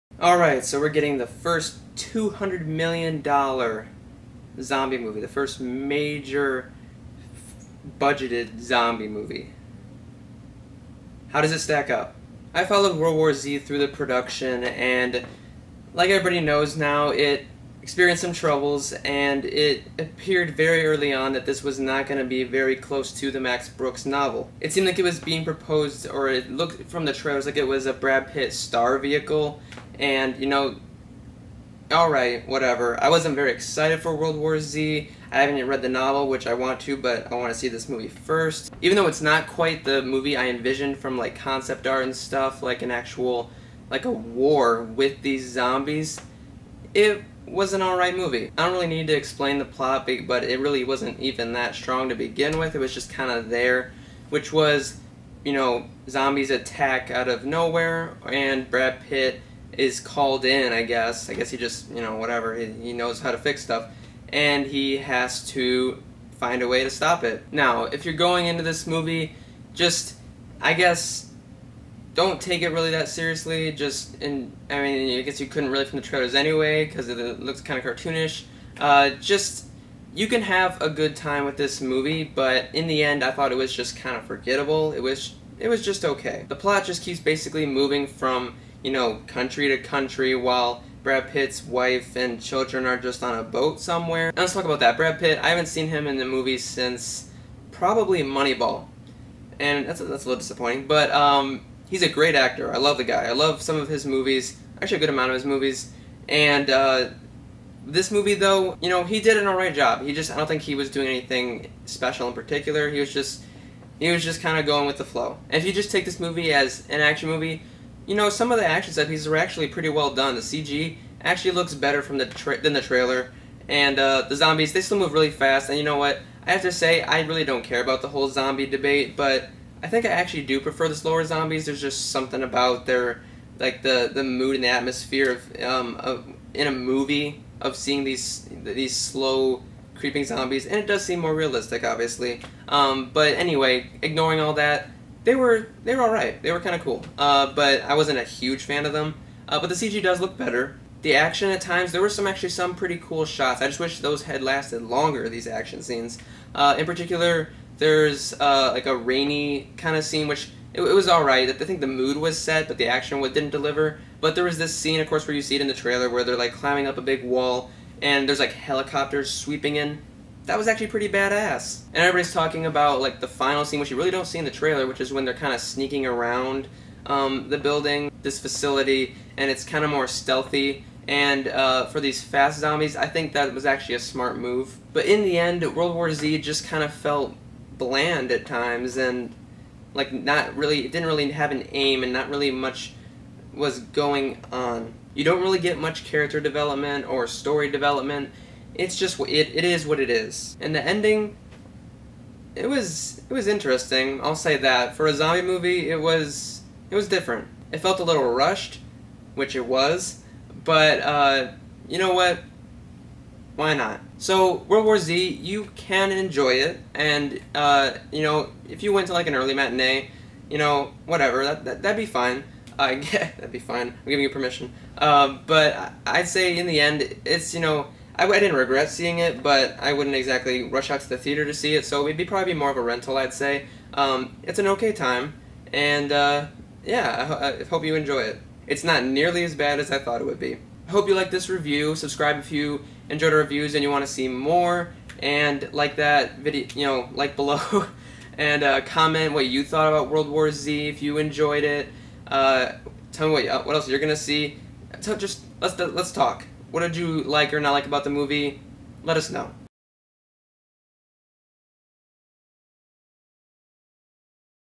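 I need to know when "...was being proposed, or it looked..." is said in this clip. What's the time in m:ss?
0:25.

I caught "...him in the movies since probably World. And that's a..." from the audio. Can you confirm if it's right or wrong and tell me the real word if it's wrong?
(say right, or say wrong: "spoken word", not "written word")
wrong: "Moneyball", not "World".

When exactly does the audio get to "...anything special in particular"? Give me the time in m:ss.
1:51.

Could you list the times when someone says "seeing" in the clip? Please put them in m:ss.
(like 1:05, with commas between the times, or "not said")
2:17, 3:48.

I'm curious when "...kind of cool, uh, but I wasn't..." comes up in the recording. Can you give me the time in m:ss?
2:26.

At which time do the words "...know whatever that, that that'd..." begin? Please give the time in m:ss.
3:40.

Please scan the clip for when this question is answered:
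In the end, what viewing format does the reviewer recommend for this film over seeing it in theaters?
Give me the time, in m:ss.
3:52.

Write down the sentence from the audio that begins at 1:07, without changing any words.
Now, if you're going into this movie, just, I guess, don't take it really that seriously.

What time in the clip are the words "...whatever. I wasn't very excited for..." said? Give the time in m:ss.
0:32.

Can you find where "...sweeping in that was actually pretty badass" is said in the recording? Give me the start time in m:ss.
2:49.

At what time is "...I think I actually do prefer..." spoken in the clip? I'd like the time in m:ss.
2:09.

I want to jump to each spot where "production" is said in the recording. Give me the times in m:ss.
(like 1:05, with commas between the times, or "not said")
0:13.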